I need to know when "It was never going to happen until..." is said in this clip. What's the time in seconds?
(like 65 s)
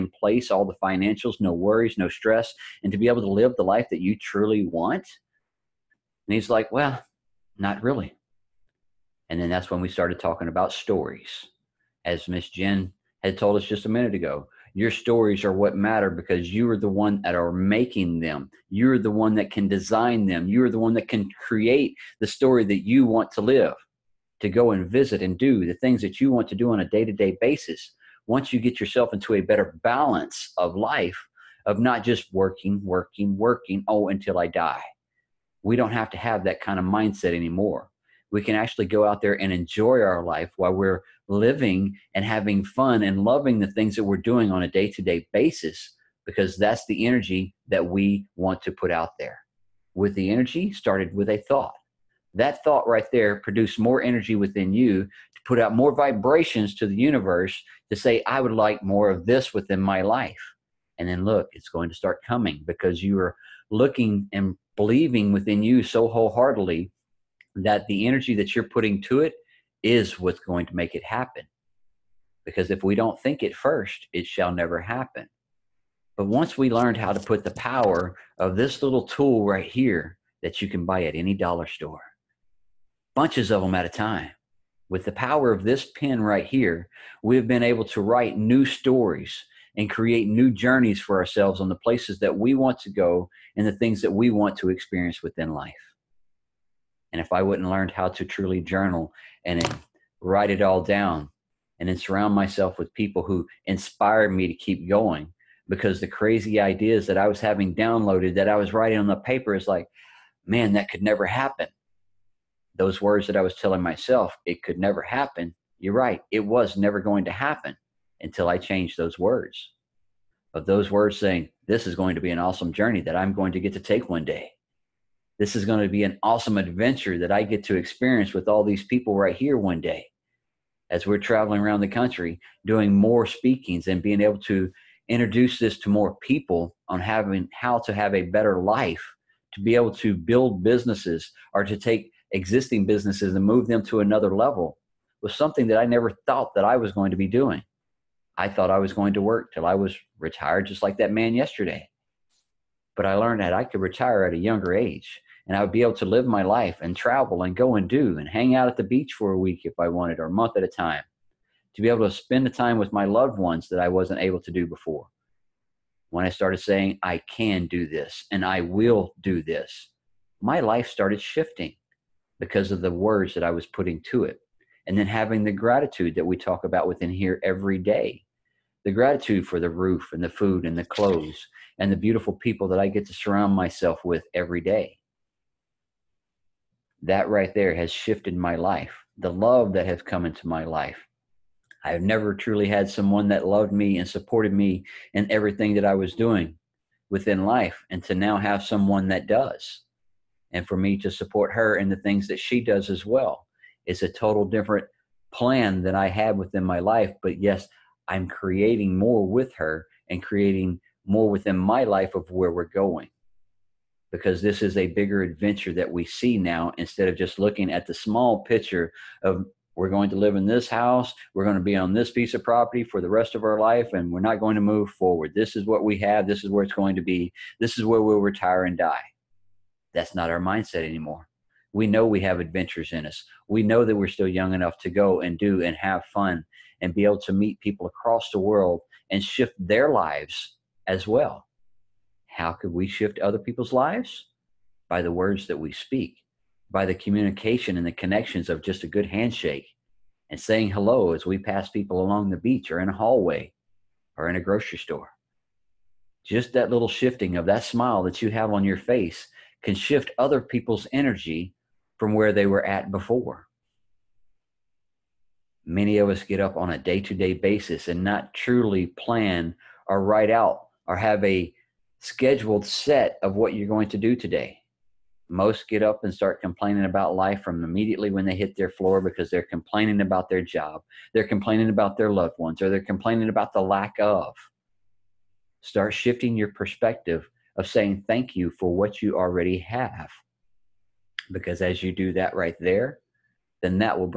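116 s.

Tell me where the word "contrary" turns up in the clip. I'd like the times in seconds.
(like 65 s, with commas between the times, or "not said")
not said.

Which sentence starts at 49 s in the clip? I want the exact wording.
With the energy started with a thought.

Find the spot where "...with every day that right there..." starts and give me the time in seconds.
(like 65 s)
184 s.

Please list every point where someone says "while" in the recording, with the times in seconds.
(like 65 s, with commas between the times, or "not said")
40 s.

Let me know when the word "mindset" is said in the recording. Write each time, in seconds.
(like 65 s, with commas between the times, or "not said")
36 s, 230 s.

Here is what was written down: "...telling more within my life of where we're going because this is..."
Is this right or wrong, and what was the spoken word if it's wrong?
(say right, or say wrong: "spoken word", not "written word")
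wrong: "creating", not "telling".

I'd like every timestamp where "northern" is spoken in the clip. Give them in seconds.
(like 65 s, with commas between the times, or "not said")
not said.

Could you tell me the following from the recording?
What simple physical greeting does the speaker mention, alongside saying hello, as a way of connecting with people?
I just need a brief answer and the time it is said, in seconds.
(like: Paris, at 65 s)
A good handshake, at 248 s.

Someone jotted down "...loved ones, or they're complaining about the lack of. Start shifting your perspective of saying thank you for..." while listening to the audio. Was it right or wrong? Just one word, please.
right.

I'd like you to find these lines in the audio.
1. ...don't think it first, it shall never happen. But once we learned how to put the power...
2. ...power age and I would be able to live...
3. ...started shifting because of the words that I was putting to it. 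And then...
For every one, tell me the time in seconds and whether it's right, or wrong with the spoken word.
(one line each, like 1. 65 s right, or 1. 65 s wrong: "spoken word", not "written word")
1. 72 s right
2. 154 s wrong: "younger", not "power"
3. 170 s right.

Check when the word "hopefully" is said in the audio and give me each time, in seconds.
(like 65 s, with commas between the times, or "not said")
not said.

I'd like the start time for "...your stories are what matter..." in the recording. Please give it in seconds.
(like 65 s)
14 s.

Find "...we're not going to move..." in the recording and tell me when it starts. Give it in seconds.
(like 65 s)
224 s.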